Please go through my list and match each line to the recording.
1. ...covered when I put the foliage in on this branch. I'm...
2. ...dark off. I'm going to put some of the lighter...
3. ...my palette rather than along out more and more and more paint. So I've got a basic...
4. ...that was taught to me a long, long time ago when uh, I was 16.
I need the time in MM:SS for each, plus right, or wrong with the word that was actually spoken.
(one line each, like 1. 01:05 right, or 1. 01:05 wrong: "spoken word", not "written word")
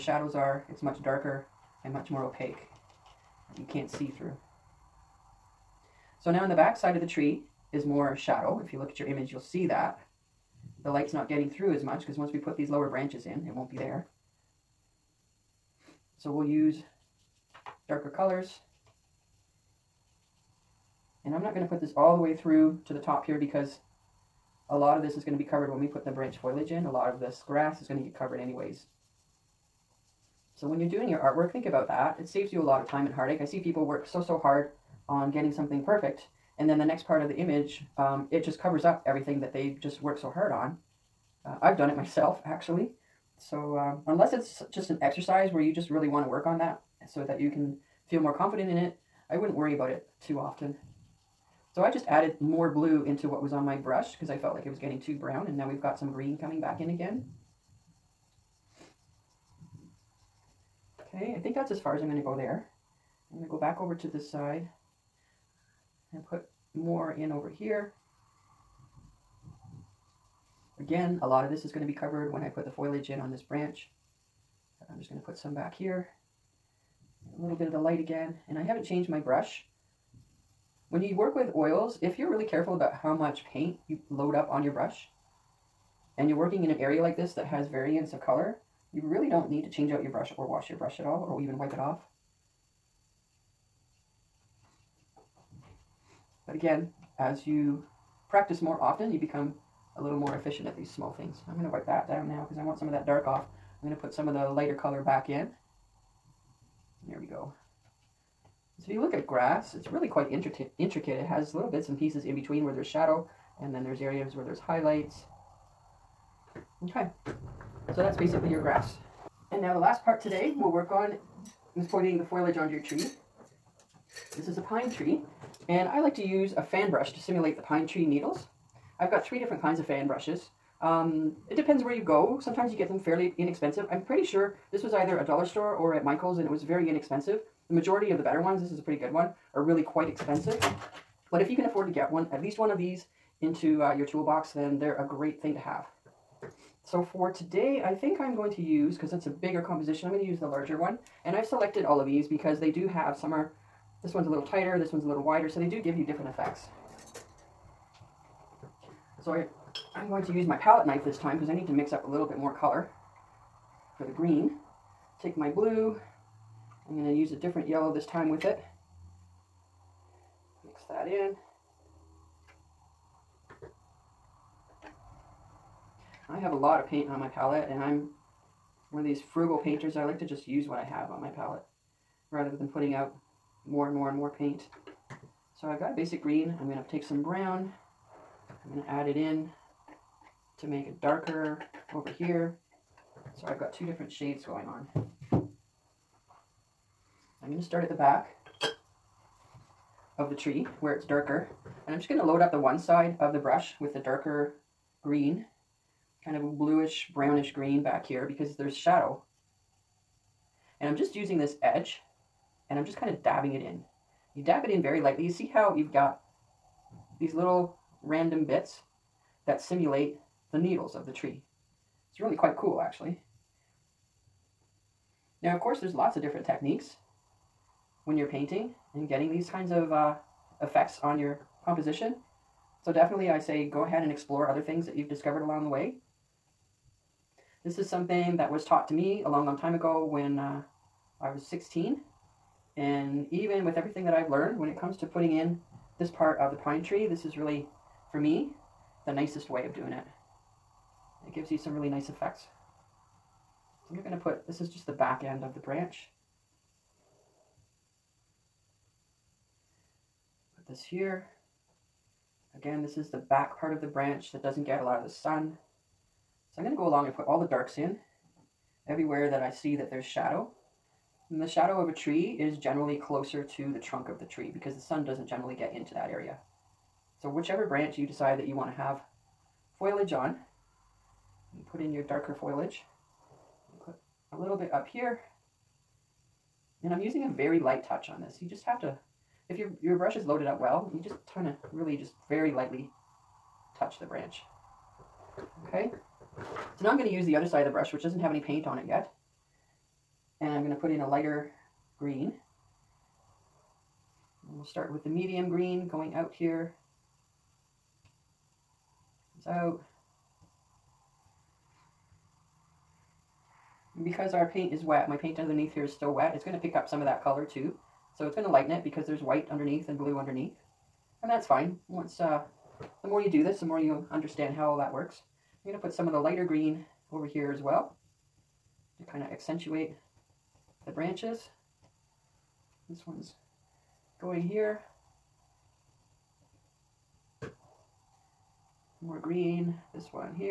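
1. 01:11 right
2. 01:43 right
3. 03:01 wrong: "putting", not "along"
4. 03:58 right.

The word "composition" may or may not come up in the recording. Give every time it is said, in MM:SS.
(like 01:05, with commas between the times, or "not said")
02:29, 03:51.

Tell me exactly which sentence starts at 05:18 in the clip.
So it's going to lighten it because there's white underneath and blue underneath.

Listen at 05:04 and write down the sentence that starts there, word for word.
And we'll start with the medium green going out here.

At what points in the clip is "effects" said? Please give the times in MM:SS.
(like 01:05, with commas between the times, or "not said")
02:36, 03:50, 04:12.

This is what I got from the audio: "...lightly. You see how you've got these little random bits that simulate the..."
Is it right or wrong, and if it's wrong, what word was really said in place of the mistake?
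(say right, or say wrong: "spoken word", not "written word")
right.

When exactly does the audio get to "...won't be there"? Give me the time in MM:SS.
00:13.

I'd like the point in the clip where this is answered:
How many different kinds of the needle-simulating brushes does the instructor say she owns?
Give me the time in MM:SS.
02:09.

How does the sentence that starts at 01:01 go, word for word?
Okay, I think that's as far as I'm going to go there.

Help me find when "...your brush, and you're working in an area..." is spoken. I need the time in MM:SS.
01:24.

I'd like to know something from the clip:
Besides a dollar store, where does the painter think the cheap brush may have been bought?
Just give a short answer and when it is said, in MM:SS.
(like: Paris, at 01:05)
Michael's, at 02:16.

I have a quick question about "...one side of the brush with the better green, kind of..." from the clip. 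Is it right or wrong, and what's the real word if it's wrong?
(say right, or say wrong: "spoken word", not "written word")
wrong: "darker", not "better".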